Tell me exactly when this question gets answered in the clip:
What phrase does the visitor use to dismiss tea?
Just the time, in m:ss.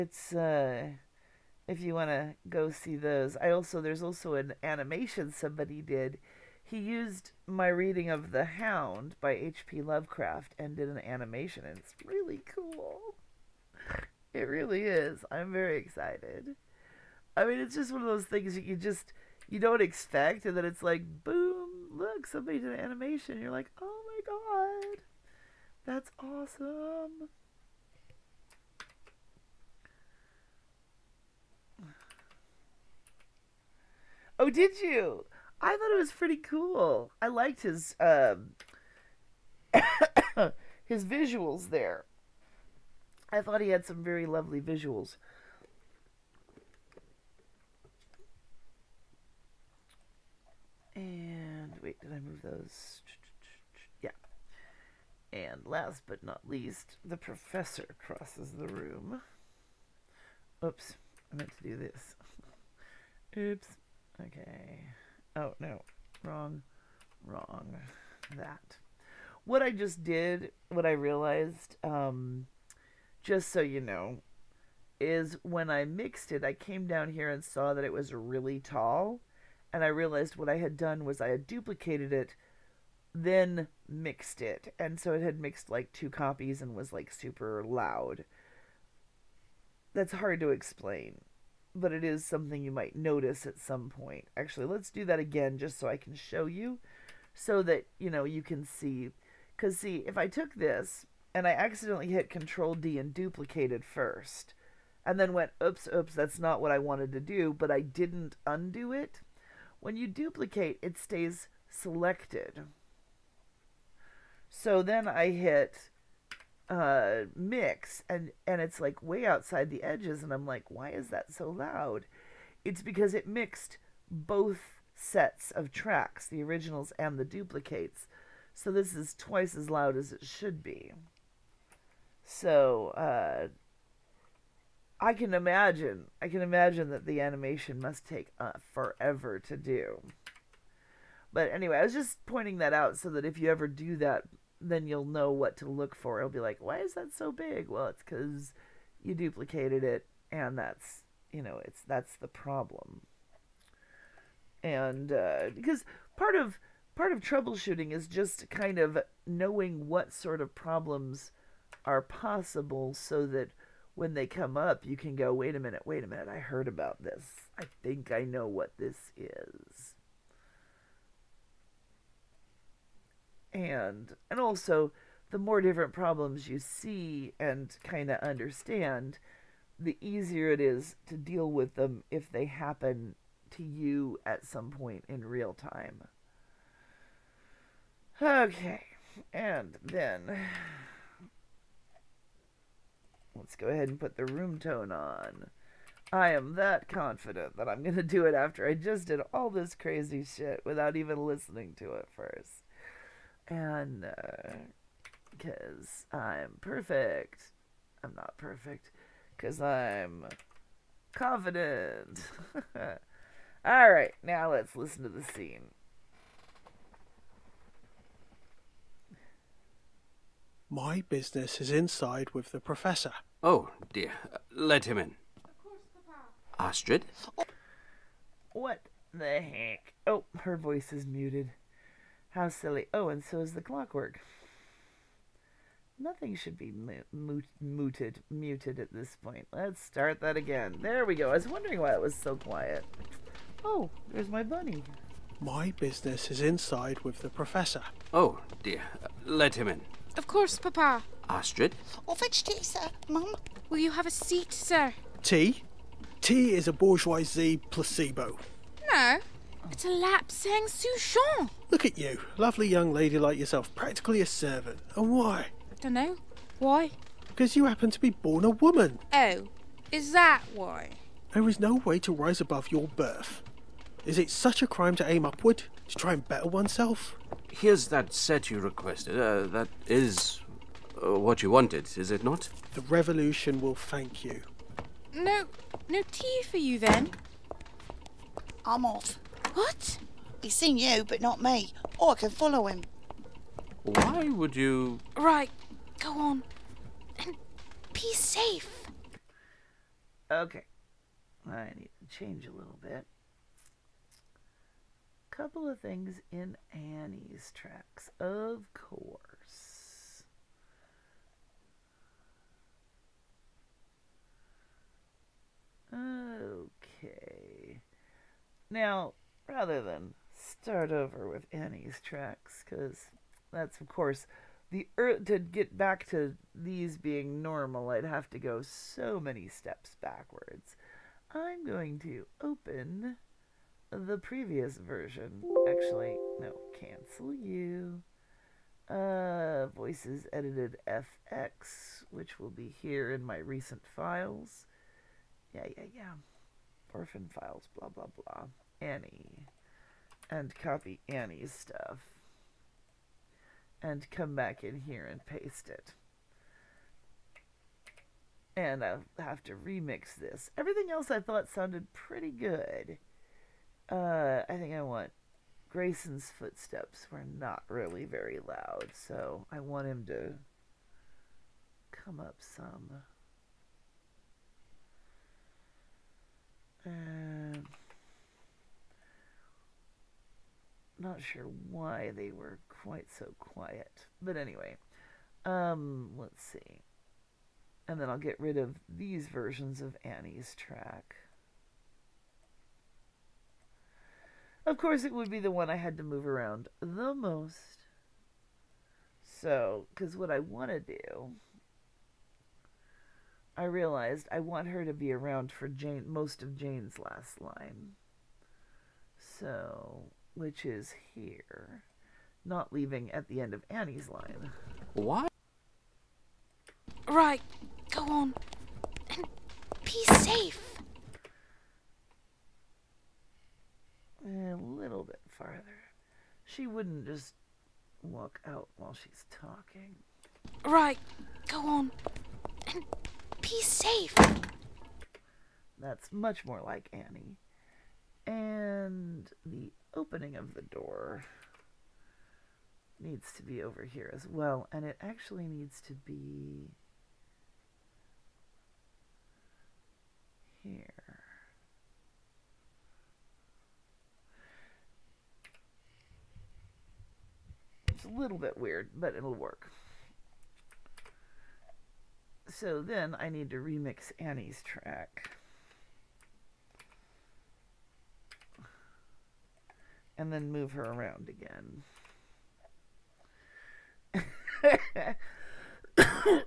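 4:16.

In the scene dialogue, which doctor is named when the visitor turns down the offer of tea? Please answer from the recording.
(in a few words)
Dr. Lapsang Souchong.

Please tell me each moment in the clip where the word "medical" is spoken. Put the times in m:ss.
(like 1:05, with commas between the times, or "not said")
not said.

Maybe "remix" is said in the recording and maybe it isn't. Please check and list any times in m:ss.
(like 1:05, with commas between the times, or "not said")
5:59, 7:43.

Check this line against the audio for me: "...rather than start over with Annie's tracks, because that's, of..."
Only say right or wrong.
right.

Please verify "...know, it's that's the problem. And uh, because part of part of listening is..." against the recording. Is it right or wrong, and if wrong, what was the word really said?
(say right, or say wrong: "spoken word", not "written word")
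wrong: "troubleshooting", not "listening".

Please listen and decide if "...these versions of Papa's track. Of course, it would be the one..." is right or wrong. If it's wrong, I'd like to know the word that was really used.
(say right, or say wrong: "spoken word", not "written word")
wrong: "Annie", not "Papa".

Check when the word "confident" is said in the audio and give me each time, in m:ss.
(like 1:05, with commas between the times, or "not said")
3:16, 3:31.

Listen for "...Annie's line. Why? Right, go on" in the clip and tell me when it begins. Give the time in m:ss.
6:53.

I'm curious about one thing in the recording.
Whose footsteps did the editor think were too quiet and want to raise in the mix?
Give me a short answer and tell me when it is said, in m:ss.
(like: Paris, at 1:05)
Grayson's, at 6:05.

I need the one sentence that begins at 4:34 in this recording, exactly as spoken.
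Is it such a crime to aim upward?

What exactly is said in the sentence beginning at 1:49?
When you duplicate, it stays selected.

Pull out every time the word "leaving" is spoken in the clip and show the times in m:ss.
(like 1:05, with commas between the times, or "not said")
6:52.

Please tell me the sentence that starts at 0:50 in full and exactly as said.
And wait, did I move those?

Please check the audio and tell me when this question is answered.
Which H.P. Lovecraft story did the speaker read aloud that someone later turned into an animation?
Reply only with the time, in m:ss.
0:08.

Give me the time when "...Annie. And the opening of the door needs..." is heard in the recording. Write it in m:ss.
7:16.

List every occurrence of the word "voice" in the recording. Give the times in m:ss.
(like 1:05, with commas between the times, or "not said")
3:50, 5:39.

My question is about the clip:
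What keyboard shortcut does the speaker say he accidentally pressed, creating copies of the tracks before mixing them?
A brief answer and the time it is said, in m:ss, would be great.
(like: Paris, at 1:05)
Control D, at 1:42.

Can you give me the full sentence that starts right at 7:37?
It's a little bit weird, but it'll work.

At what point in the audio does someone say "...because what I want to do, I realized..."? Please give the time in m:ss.
6:39.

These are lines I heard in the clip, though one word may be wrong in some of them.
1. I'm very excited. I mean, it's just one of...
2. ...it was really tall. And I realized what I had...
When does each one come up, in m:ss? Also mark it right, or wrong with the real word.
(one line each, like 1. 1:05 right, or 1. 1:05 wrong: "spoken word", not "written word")
1. 0:15 right
2. 1:17 right.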